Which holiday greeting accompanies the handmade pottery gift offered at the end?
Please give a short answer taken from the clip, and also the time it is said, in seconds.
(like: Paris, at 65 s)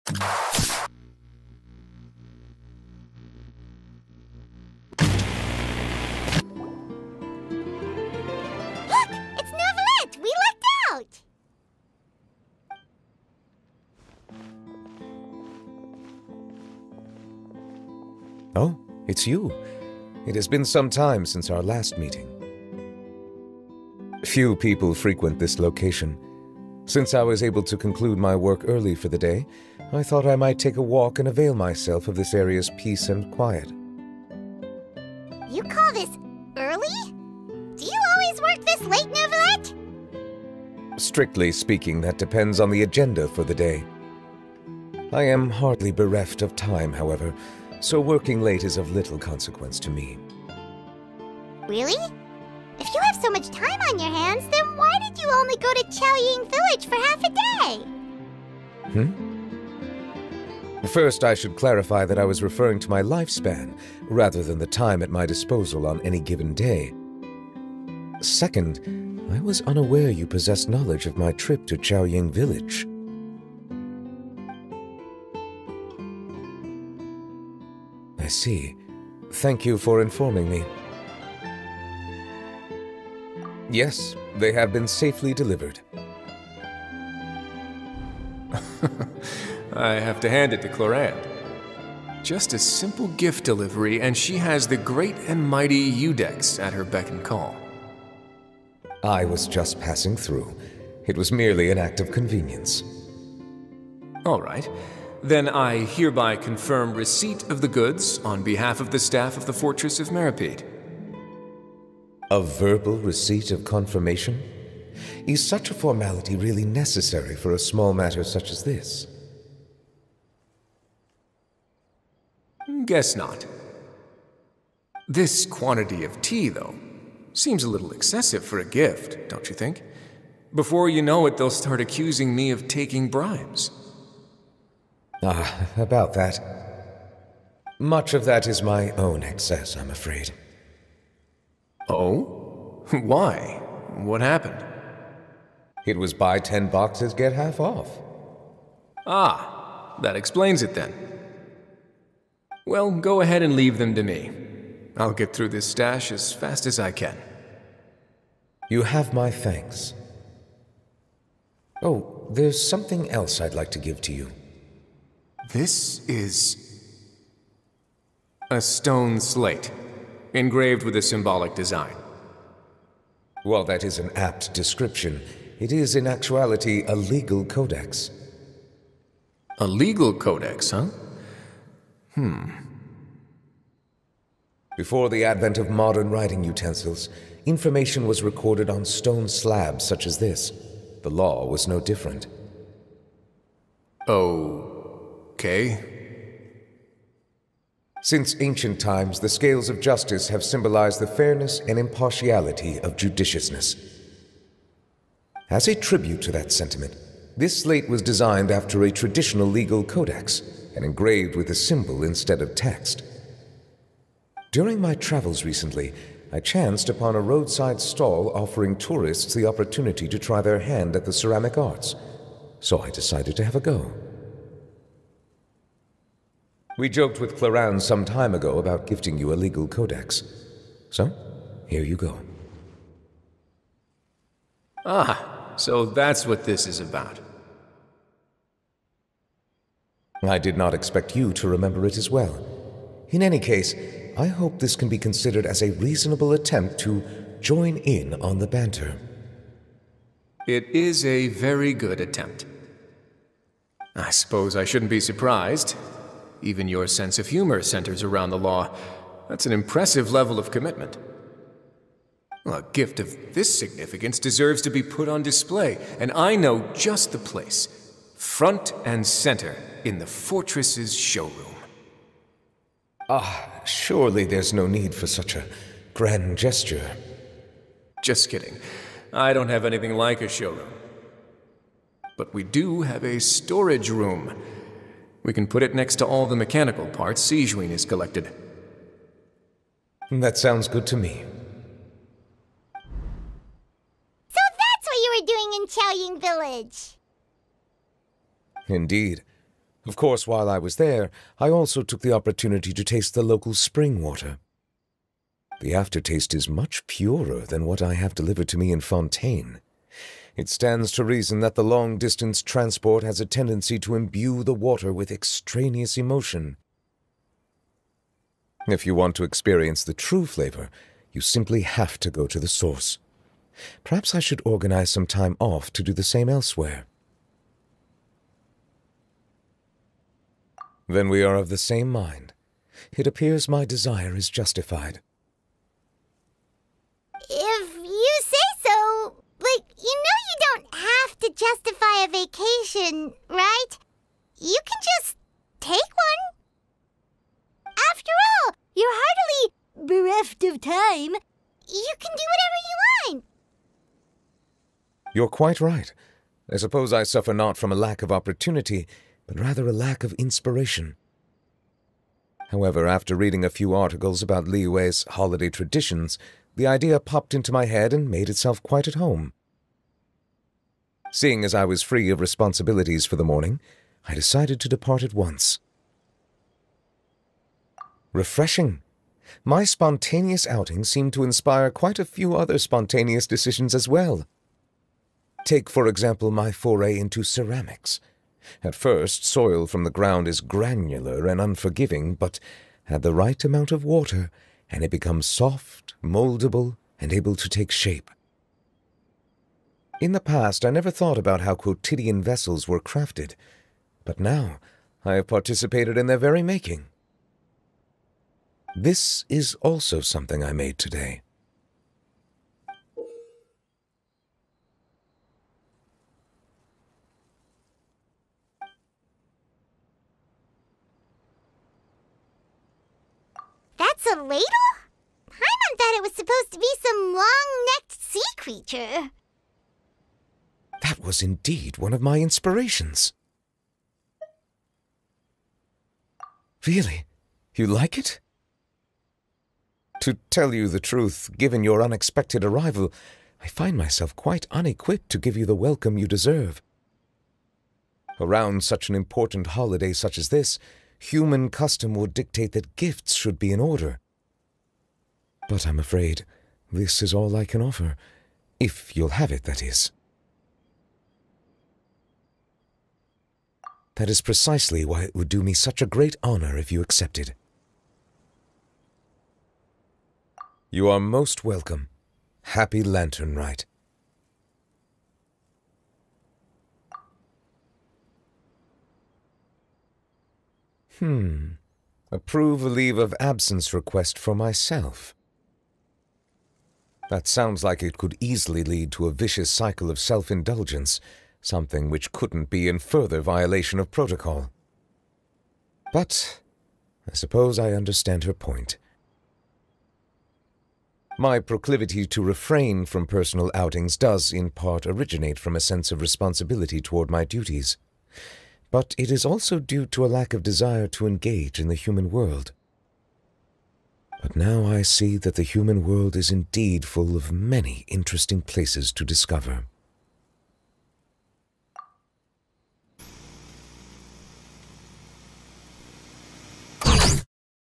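Happy Lantern Rite, at 472 s.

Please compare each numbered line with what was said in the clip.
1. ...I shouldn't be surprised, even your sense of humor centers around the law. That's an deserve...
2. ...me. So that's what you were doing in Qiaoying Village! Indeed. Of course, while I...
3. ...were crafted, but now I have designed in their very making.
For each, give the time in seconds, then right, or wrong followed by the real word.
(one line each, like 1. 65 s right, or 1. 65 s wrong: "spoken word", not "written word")
1. 254 s wrong: "impressive", not "deserve"
2. 290 s right
3. 402 s wrong: "participated", not "designed".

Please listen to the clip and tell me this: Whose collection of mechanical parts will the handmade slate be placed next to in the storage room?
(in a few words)
Sigewinne.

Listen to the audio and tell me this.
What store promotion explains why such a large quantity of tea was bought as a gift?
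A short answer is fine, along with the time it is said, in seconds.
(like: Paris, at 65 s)
Buy ten boxes, get half off, at 146 s.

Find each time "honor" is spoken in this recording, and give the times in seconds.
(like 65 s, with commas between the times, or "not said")
466 s.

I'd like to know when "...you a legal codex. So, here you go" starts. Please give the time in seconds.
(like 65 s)
229 s.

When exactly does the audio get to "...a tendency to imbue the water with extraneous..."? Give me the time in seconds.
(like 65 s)
313 s.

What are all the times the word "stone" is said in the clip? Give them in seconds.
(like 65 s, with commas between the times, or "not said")
168 s, 188 s.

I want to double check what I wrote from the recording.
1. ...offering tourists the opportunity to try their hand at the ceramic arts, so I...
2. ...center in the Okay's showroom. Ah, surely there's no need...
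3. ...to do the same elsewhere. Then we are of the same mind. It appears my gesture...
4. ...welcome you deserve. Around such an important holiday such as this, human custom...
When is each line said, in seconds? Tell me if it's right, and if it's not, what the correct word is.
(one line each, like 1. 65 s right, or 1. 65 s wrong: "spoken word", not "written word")
1. 218 s right
2. 269 s wrong: "Fortress", not "Okay"
3. 325 s wrong: "desire", not "gesture"
4. 445 s right.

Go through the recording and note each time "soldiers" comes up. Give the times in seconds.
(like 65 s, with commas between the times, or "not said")
not said.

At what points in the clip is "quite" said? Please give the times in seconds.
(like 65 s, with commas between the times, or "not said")
355 s, 368 s, 381 s, 444 s.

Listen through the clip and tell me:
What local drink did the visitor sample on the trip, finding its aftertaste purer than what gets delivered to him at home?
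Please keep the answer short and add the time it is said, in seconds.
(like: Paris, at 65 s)
Spring water, at 303 s.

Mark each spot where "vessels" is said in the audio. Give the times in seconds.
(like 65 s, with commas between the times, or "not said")
402 s.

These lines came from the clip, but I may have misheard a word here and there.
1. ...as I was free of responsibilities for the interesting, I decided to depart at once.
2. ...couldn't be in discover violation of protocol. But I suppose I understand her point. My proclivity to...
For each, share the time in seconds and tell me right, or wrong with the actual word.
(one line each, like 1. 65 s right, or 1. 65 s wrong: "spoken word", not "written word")
1. 371 s wrong: "morning", not "interesting"
2. 492 s wrong: "further", not "discover".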